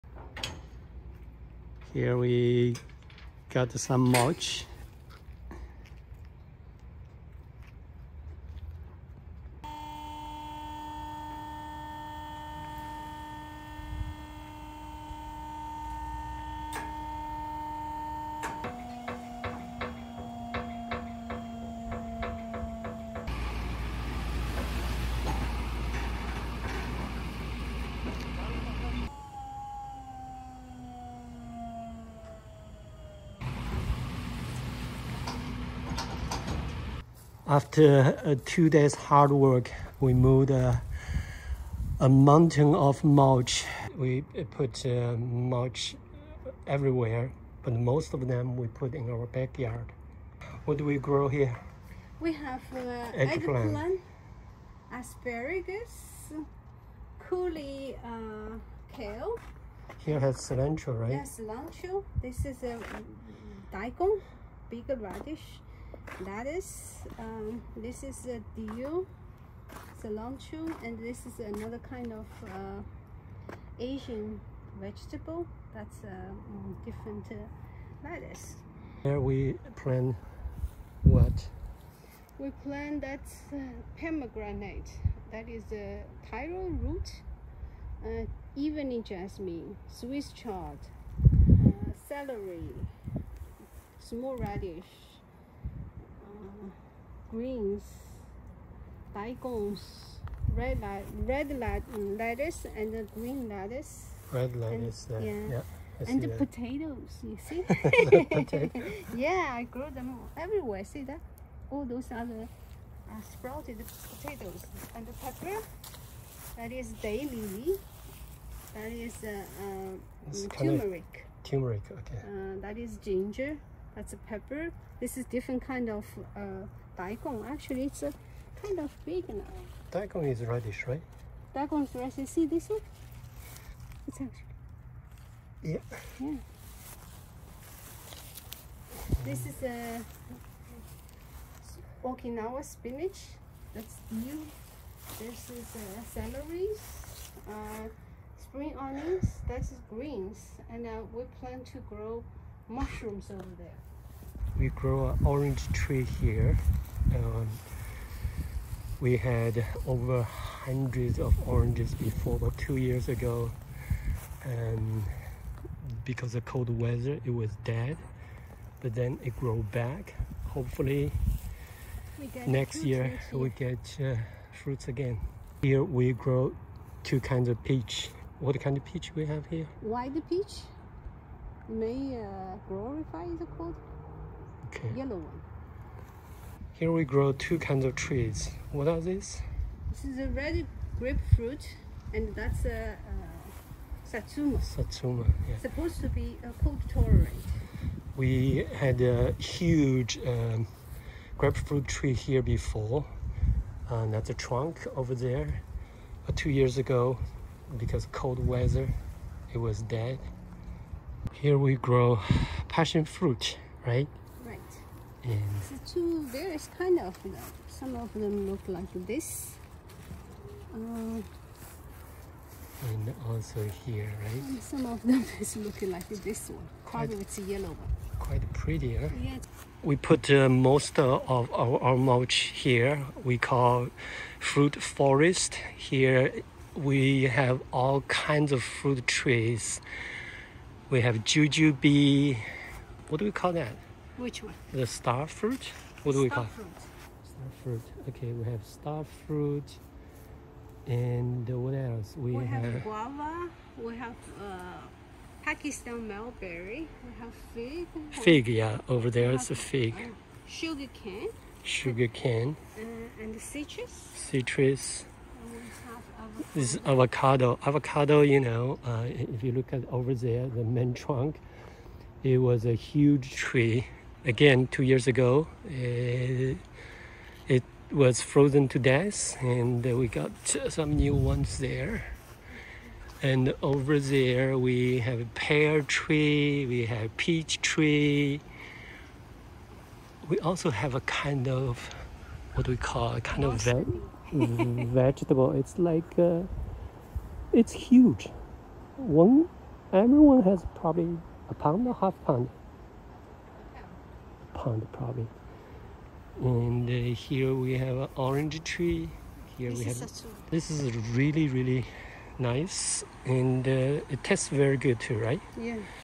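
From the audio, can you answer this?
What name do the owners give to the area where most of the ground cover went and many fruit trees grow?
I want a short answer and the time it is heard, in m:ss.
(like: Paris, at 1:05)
Fruit forest, at 3:54.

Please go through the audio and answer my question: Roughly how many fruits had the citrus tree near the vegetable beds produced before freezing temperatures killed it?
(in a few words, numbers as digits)
Over hundreds.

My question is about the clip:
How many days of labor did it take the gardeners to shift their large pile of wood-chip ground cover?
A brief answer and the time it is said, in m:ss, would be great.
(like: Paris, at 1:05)
2 days, at 0:38.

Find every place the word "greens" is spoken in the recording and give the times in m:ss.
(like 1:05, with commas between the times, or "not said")
1:37, 1:43, 2:29.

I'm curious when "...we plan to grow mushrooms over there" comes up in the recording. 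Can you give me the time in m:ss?
2:31.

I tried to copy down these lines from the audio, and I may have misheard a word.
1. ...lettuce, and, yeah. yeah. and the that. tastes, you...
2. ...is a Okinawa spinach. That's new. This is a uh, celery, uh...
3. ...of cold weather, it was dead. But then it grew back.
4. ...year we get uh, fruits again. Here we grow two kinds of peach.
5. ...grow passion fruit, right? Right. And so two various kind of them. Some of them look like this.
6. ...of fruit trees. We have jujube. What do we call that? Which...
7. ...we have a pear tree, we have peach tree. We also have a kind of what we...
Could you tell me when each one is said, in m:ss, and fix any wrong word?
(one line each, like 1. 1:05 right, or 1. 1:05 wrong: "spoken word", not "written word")
1. 1:44 wrong: "potatoes", not "tastes"
2. 2:19 right
3. 2:46 right
4. 2:52 right
5. 3:31 right
6. 3:58 right
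7. 4:44 right.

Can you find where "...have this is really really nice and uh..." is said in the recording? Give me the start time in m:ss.
5:09.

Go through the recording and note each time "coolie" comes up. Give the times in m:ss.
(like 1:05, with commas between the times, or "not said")
0:57.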